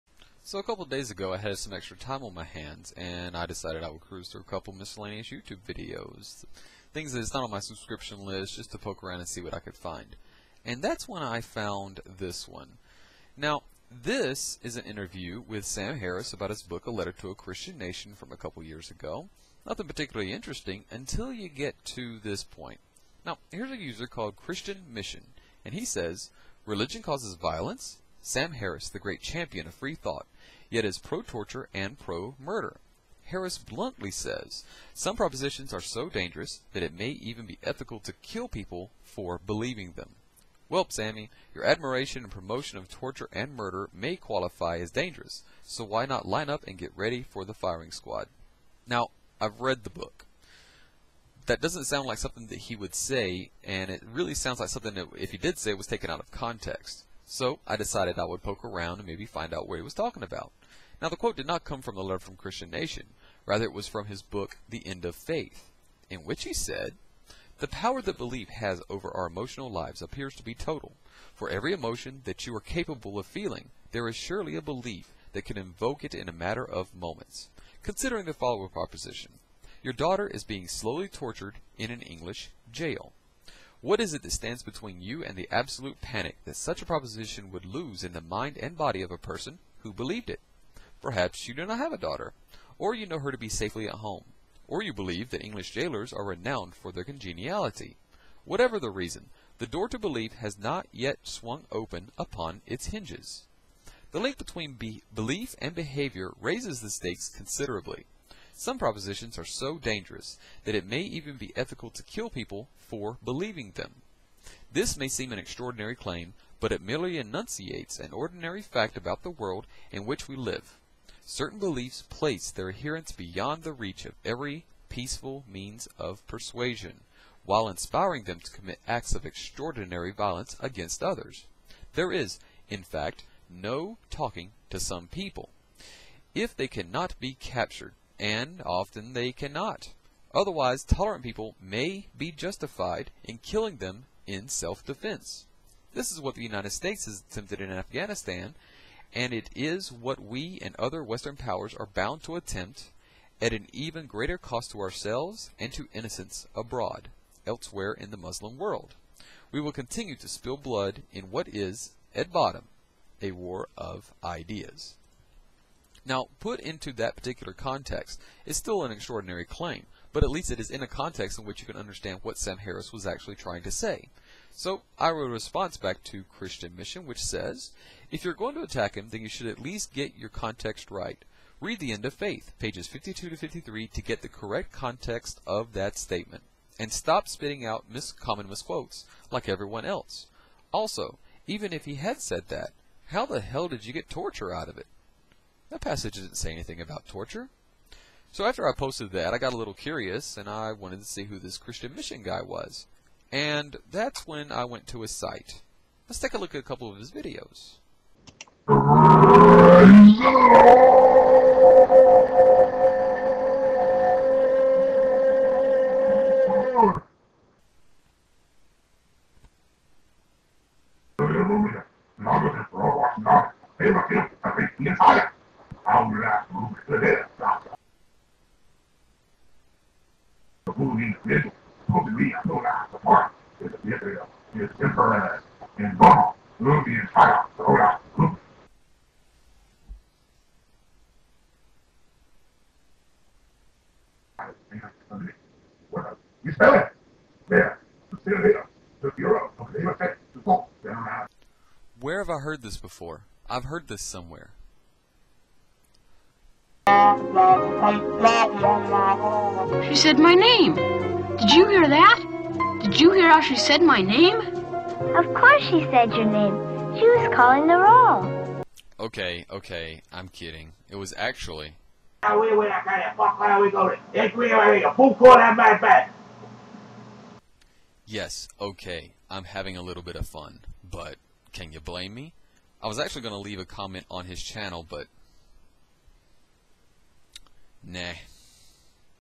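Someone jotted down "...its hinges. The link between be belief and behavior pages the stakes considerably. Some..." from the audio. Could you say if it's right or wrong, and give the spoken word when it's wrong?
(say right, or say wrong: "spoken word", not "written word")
wrong: "raises", not "pages".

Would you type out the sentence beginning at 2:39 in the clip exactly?
We will continue to spill blood in what is, at bottom, a war of ideas.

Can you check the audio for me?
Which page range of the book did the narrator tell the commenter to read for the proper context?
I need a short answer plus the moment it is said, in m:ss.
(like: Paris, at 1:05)
52 to 53, at 3:02.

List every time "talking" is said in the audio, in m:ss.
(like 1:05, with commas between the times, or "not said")
0:59, 2:14.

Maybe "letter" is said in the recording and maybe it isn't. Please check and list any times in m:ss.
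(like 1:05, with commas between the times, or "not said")
0:16, 1:02.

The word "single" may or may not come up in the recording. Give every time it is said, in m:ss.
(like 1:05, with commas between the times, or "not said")
not said.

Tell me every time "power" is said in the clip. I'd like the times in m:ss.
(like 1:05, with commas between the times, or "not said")
1:07, 2:31.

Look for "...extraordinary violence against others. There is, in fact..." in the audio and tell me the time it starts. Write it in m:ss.
2:09.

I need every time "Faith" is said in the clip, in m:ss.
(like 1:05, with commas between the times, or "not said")
1:05, 3:02.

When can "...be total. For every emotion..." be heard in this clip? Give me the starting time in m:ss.
1:10.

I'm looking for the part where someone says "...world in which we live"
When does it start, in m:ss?
1:59.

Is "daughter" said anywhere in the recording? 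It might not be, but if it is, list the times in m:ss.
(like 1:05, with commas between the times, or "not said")
1:19, 1:31.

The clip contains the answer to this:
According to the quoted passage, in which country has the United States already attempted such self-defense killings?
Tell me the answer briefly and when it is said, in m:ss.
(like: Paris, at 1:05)
Afghanistan, at 2:27.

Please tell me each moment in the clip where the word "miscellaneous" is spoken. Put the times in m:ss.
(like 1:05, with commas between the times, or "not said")
0:04.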